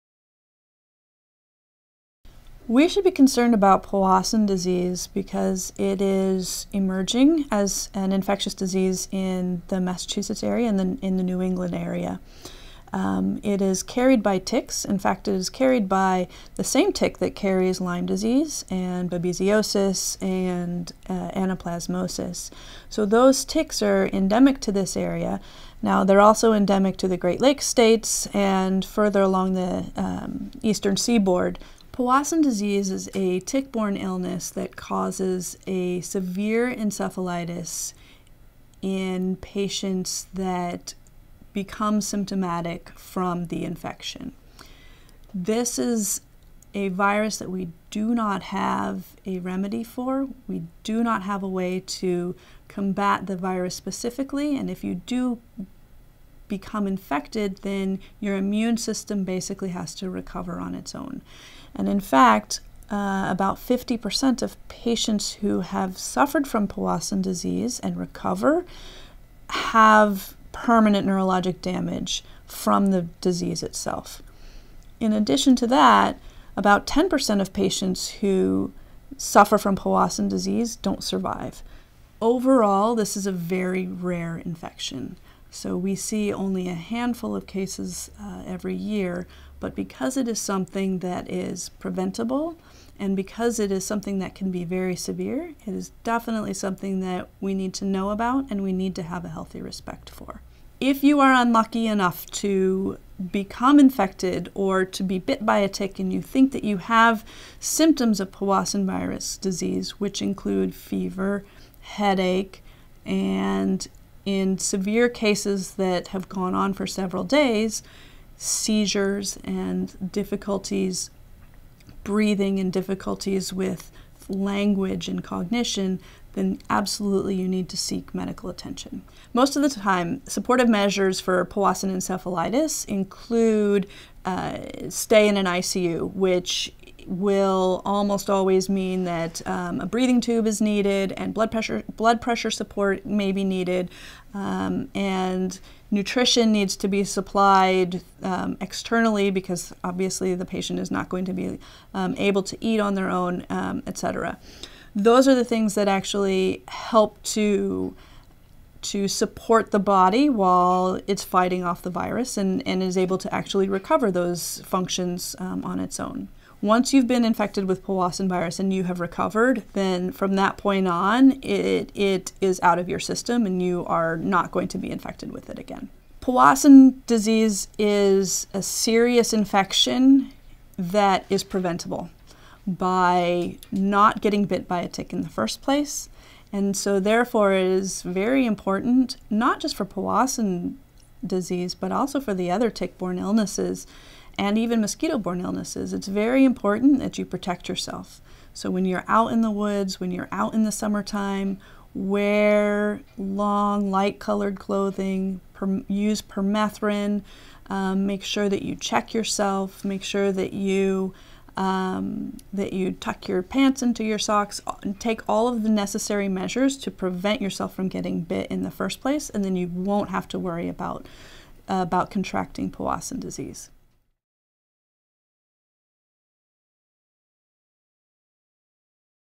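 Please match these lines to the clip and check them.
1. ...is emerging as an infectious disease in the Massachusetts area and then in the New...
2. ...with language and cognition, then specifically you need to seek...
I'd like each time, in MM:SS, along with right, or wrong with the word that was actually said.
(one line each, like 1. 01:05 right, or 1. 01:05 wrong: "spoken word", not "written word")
1. 00:06 right
2. 02:03 wrong: "absolutely", not "specifically".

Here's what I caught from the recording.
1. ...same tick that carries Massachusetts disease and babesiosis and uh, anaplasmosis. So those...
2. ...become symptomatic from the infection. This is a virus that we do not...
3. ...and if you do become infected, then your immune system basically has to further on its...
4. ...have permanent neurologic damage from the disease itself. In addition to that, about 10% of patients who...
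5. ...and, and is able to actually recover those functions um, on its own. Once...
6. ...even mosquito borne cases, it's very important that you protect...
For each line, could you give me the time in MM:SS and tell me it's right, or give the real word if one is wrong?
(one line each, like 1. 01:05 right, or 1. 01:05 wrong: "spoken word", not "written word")
1. 00:16 wrong: "Lyme", not "Massachusetts"
2. 00:41 right
3. 00:54 wrong: "recover", not "further"
4. 01:09 right
5. 02:42 right
6. 03:14 wrong: "illnesses", not "cases".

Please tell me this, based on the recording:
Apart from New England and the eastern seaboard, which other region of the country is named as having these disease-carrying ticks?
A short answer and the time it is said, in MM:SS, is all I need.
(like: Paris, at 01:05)
Great Lakes states, at 00:27.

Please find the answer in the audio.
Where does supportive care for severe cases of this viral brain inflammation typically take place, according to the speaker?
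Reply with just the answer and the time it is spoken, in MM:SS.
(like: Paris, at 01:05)
ICU, at 02:15.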